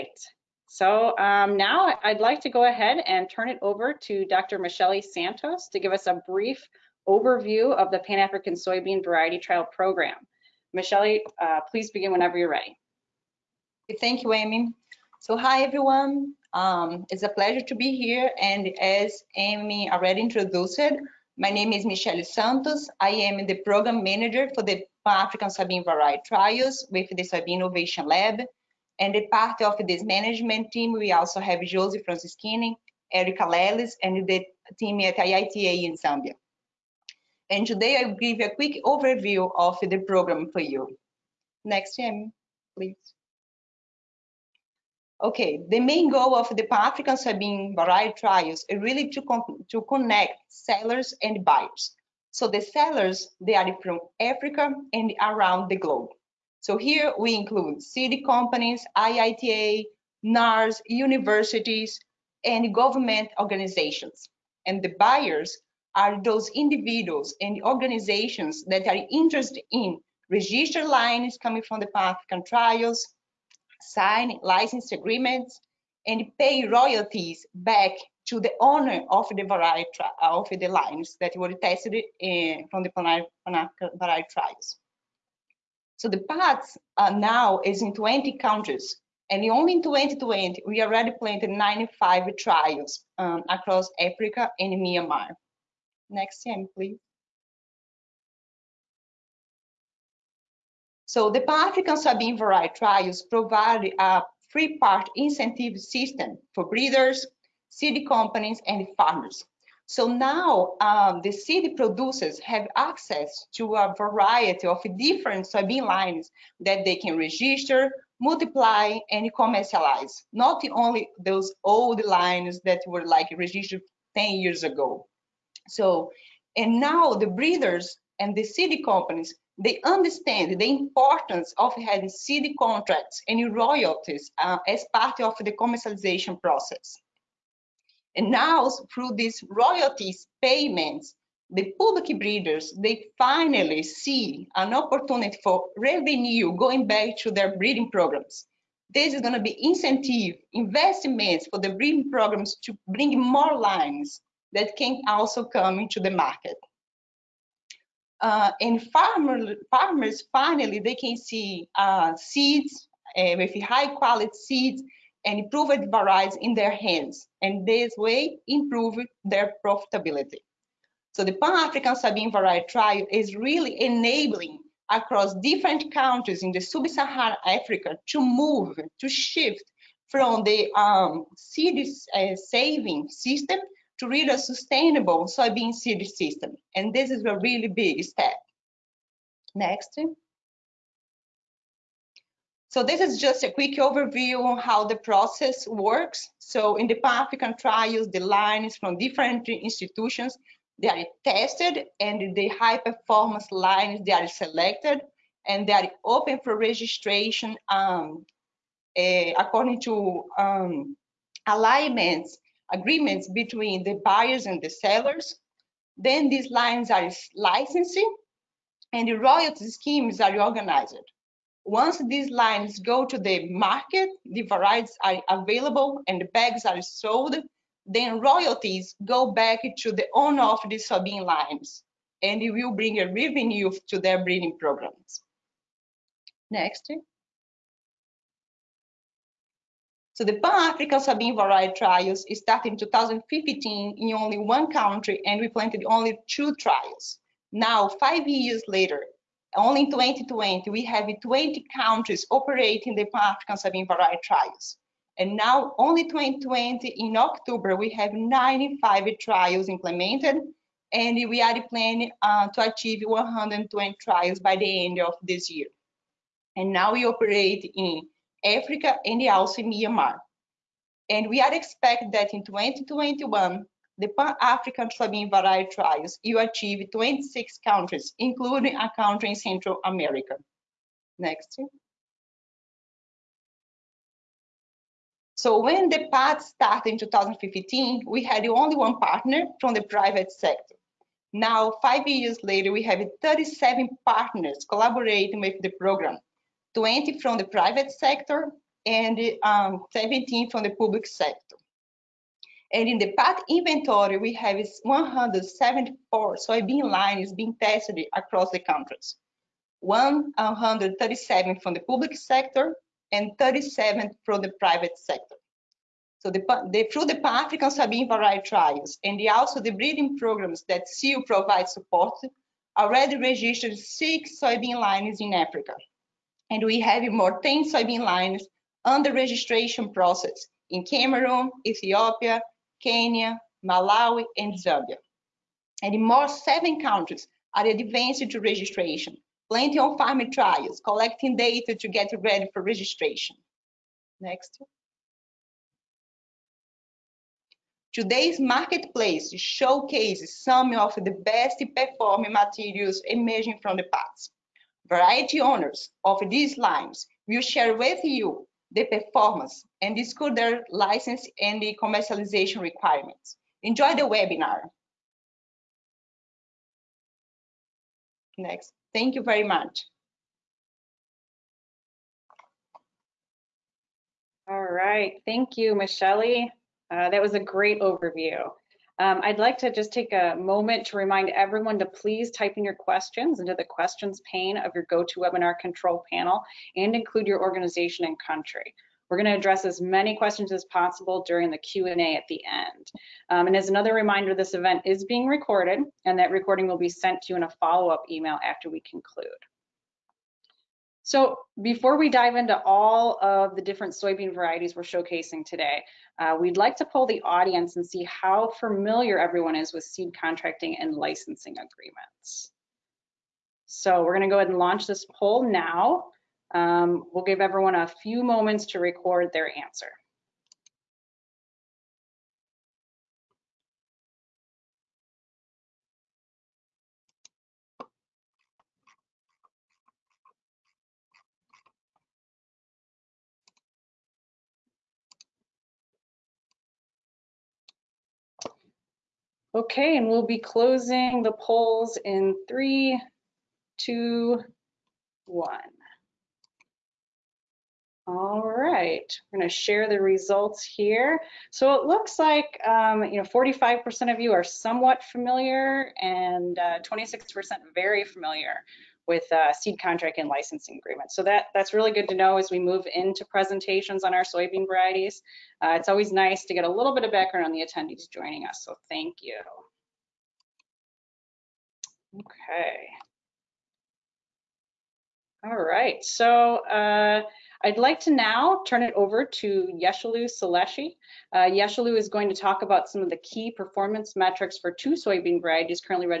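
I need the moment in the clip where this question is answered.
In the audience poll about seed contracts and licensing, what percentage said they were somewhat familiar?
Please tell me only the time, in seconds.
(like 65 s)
453 s.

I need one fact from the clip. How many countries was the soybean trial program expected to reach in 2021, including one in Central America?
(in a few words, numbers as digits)
26.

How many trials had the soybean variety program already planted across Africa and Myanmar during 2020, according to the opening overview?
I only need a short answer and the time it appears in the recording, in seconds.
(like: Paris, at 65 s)
95, at 91 s.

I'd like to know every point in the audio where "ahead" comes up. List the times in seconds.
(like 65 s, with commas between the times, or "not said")
2 s, 414 s.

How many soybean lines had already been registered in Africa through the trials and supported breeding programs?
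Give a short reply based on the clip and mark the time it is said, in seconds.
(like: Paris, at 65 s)
6, at 323 s.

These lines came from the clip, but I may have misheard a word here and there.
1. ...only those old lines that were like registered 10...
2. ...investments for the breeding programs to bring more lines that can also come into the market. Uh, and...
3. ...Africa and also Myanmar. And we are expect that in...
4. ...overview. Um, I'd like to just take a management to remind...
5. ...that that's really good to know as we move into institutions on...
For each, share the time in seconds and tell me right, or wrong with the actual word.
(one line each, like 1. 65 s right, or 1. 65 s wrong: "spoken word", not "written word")
1. 120 s right
2. 150 s right
3. 268 s right
4. 377 s wrong: "moment", not "management"
5. 461 s wrong: "presentations", not "institutions".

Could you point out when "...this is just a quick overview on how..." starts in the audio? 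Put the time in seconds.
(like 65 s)
192 s.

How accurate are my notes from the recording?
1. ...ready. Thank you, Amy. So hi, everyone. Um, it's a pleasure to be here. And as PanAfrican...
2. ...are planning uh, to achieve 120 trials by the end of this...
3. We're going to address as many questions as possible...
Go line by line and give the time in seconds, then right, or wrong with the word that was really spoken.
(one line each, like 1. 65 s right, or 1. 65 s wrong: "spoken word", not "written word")
1. 12 s wrong: "Amy", not "PanAfrican"
2. 261 s right
3. 389 s right.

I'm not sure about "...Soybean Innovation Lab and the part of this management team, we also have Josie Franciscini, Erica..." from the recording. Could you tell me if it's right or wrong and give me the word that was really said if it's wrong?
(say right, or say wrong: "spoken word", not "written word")
right.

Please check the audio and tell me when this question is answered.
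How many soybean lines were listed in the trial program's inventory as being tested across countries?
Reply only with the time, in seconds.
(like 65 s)
304 s.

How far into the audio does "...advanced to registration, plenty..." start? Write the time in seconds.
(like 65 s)
337 s.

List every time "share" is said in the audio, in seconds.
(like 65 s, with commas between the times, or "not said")
357 s, 449 s.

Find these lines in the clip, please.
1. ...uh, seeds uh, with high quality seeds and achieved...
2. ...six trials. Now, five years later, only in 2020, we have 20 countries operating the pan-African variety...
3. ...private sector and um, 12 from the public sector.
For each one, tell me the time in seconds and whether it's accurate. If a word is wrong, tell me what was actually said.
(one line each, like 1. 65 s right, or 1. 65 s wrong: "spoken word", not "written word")
1. 161 s wrong: "improved", not "achieved"
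2. 246 s wrong: "two", not "six"
3. 297 s wrong: "17", not "12".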